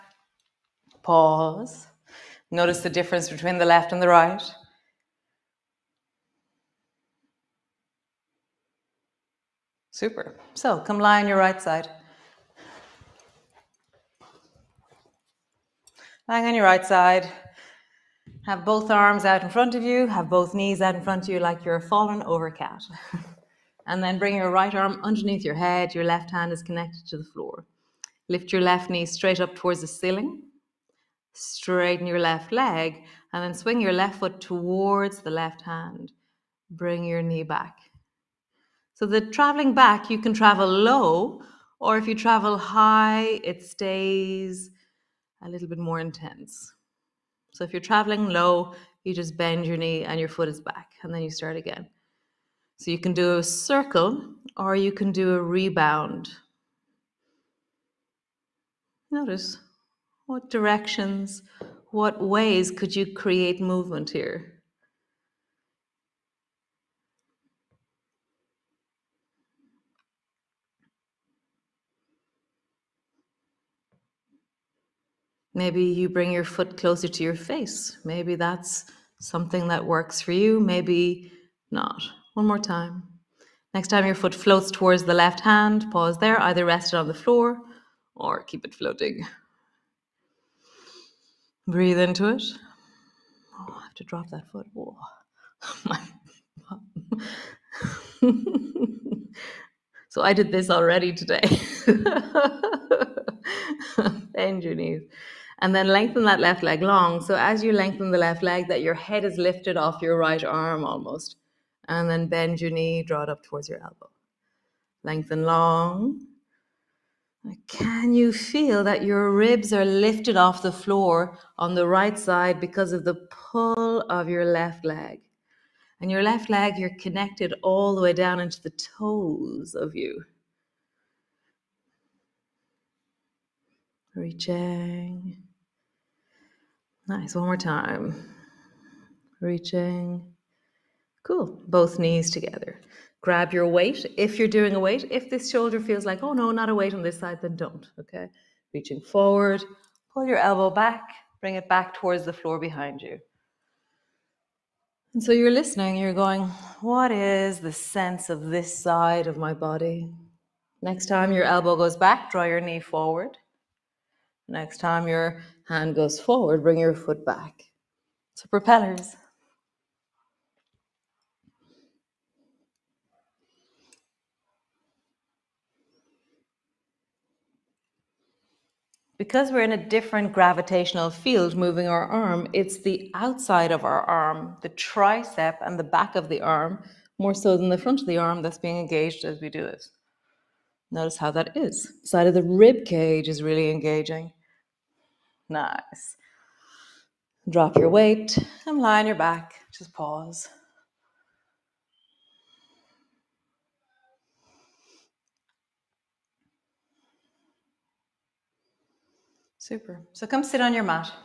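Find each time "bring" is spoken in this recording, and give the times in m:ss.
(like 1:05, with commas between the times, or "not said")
0:24, 0:36, 1:16, 2:31, 2:46.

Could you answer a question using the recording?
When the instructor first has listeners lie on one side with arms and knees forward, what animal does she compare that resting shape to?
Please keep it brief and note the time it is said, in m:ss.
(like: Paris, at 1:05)
fallen over cat, at 0:21.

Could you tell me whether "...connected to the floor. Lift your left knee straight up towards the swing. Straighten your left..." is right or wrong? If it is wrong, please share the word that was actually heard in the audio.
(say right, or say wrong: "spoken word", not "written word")
wrong: "ceiling", not "swing".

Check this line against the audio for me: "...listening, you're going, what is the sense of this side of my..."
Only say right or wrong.
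right.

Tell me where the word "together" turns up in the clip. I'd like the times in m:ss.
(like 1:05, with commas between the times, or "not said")
2:22.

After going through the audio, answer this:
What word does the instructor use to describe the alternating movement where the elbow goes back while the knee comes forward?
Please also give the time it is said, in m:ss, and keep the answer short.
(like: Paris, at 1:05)
propellers, at 2:48.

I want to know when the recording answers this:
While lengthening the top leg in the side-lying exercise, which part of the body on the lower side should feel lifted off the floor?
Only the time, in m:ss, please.
1:59.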